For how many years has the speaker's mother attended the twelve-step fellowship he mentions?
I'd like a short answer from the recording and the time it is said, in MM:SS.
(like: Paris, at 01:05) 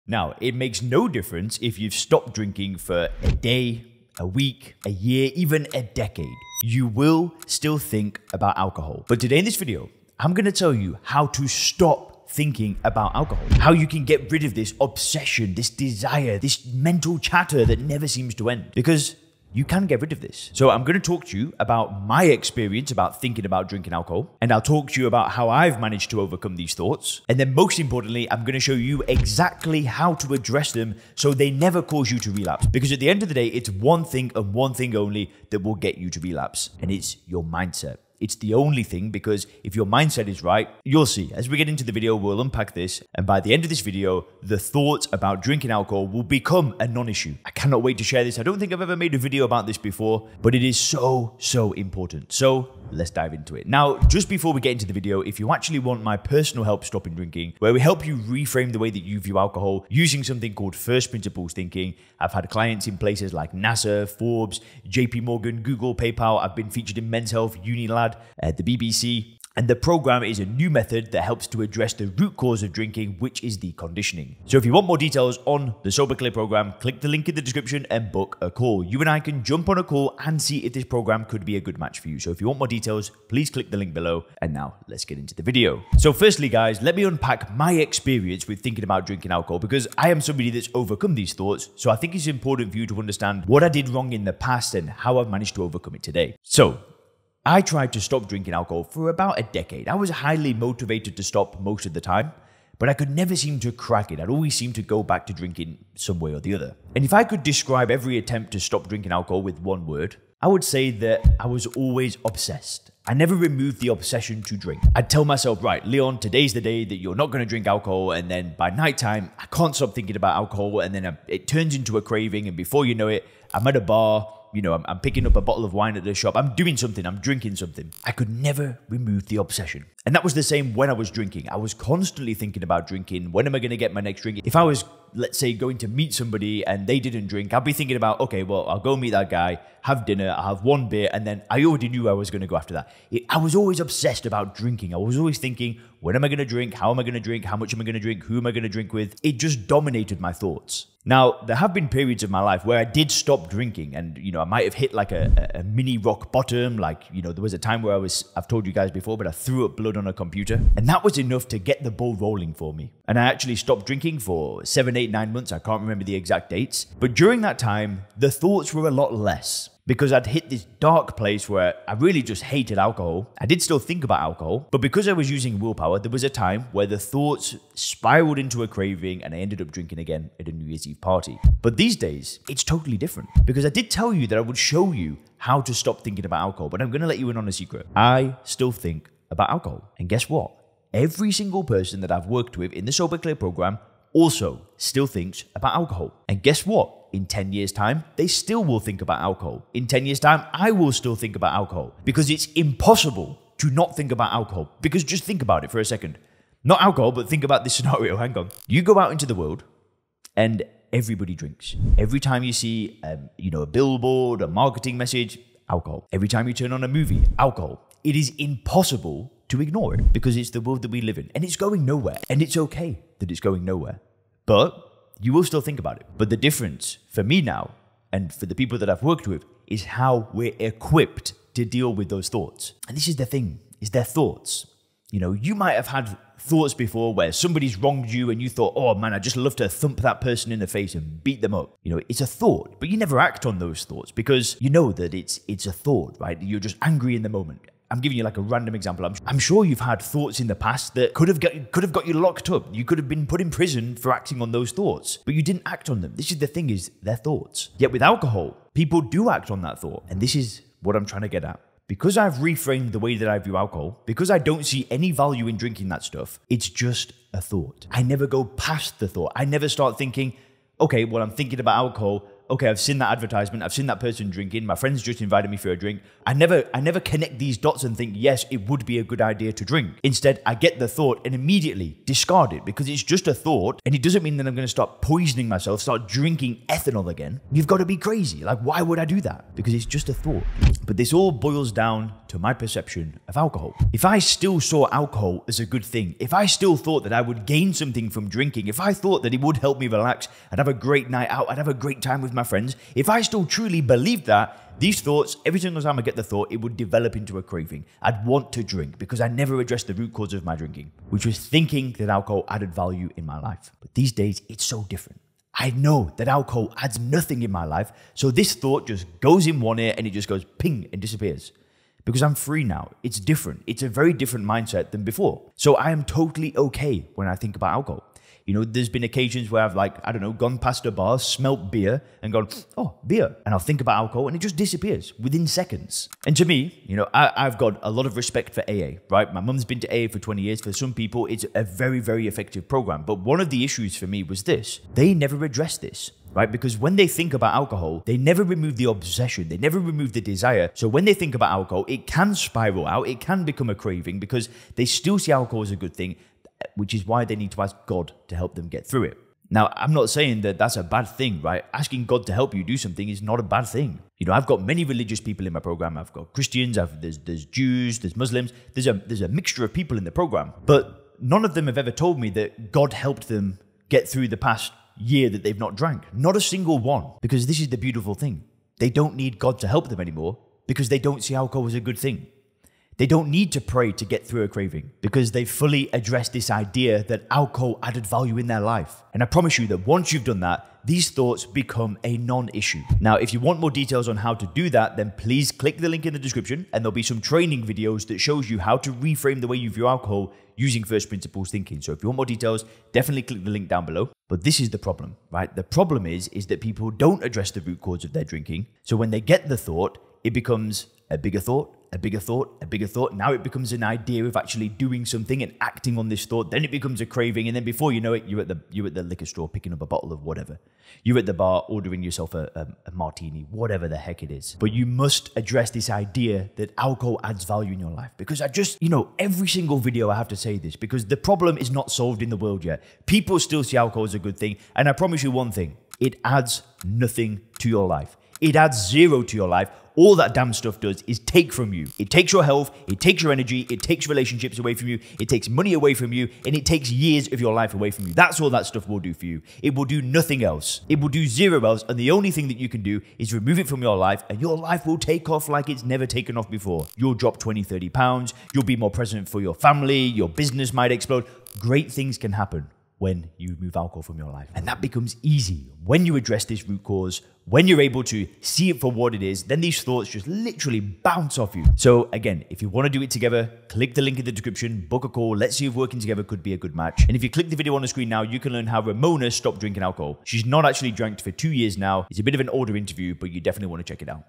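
20, at 05:40.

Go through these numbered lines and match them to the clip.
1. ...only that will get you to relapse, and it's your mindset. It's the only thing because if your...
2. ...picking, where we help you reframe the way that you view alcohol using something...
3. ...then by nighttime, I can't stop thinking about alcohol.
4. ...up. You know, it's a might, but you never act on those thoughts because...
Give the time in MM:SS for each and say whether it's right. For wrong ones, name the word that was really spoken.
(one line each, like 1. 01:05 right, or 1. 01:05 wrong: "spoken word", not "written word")
1. 00:34 right
2. 00:57 wrong: "drinking", not "picking"
3. 01:58 right
4. 04:01 wrong: "thought", not "might".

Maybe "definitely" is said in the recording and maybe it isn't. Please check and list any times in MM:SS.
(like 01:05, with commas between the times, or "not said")
06:42, 08:03.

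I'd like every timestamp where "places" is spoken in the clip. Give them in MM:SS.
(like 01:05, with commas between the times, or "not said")
01:02, 02:51.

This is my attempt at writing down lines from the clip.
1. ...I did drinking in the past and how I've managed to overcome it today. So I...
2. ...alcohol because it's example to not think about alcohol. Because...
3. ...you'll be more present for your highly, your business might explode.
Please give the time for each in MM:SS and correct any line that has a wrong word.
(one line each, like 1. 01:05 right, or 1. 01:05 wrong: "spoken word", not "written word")
1. 01:33 wrong: "wrong", not "drinking"
2. 03:21 wrong: "impossible", not "example"
3. 07:38 wrong: "family", not "highly".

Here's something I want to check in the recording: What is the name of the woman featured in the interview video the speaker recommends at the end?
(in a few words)
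Ramona.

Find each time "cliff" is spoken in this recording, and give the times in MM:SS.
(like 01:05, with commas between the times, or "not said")
not said.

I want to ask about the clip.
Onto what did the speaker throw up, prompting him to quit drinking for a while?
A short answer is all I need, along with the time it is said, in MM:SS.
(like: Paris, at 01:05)
a computer, at 02:40.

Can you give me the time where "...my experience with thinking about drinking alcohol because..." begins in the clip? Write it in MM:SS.
01:27.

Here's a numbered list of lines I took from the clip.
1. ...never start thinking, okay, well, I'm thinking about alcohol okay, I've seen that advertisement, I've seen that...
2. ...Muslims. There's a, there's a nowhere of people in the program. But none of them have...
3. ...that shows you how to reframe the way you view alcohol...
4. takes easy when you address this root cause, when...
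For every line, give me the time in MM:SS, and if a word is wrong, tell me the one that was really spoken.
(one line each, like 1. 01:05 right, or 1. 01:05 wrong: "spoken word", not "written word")
1. 04:29 right
2. 06:08 wrong: "mixture", not "nowhere"
3. 06:38 right
4. 07:44 wrong: "becomes", not "takes".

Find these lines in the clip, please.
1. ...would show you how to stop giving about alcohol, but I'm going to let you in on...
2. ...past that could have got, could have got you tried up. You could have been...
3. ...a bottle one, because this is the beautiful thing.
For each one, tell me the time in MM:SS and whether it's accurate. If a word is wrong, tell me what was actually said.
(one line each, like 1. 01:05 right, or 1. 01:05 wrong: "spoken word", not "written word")
1. 03:04 wrong: "thinking", not "giving"
2. 04:10 wrong: "locked", not "tried"
3. 06:16 wrong: "single", not "bottle".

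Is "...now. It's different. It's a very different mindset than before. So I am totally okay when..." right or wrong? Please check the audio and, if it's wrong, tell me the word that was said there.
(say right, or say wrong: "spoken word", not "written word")
right.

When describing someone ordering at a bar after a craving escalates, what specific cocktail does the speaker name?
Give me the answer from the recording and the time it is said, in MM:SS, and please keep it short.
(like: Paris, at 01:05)
martini, at 07:02.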